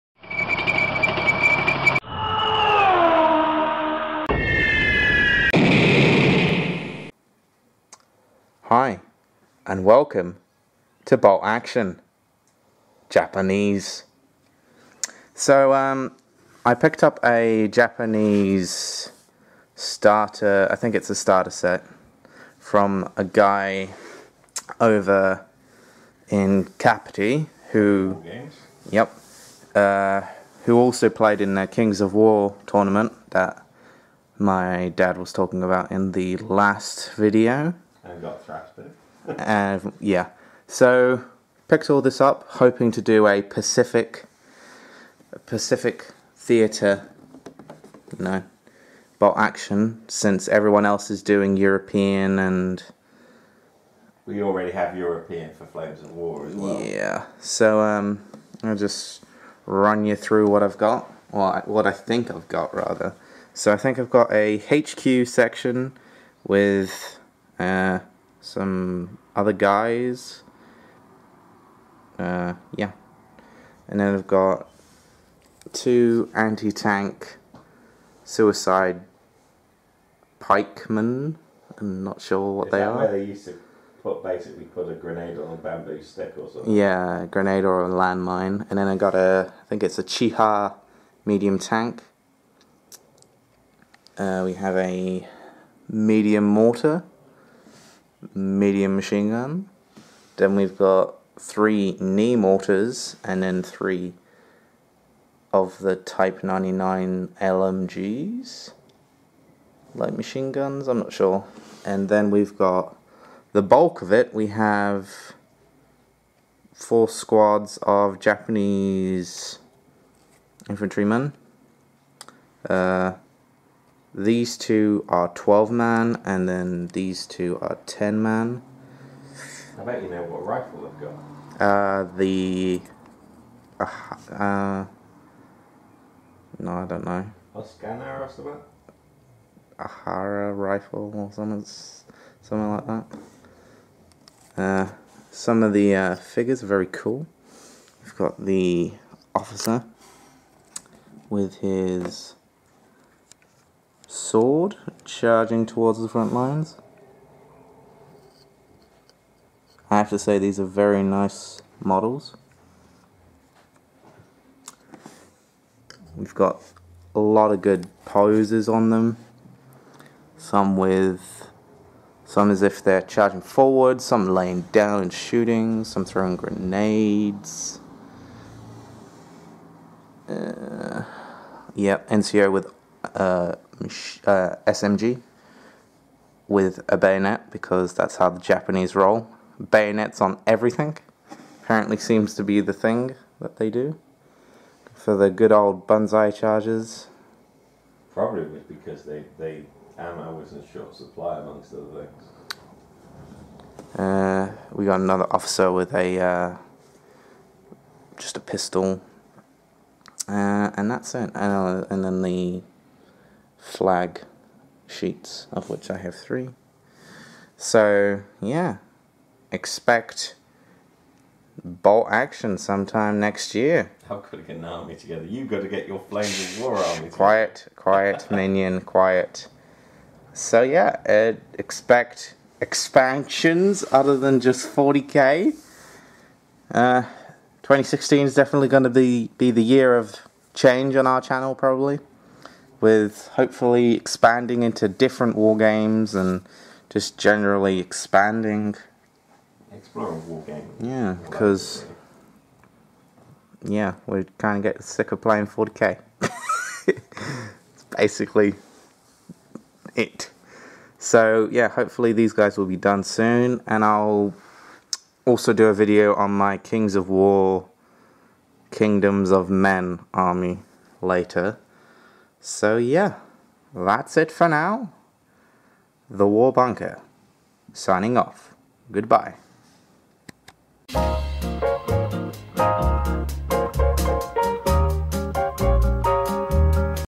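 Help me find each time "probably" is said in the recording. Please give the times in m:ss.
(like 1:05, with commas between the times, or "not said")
3:18, 4:01.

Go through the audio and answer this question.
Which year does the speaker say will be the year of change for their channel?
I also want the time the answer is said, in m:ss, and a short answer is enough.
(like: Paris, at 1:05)
2016, at 3:57.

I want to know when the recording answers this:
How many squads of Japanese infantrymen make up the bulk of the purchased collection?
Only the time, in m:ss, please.
1:56.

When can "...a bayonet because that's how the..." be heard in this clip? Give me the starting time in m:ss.
3:06.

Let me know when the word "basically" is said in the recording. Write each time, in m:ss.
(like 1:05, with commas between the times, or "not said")
1:24, 4:17.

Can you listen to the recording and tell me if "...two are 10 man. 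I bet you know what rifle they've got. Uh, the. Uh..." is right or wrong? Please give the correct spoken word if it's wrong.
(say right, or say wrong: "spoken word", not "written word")
right.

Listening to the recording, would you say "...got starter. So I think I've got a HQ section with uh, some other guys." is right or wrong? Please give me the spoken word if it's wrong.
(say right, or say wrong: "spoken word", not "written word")
wrong: "rather", not "starter".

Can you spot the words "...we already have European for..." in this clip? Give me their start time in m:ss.
0:54.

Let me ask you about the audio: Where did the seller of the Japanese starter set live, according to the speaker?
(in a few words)
Kapiti.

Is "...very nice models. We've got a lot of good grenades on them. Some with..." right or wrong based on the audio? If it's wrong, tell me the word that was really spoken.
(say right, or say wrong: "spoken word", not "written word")
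wrong: "poses", not "grenades".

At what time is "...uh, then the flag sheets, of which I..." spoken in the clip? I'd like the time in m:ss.
3:31.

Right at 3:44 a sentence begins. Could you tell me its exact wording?
How could I get an army together.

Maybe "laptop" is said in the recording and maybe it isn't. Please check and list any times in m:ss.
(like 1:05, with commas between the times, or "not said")
not said.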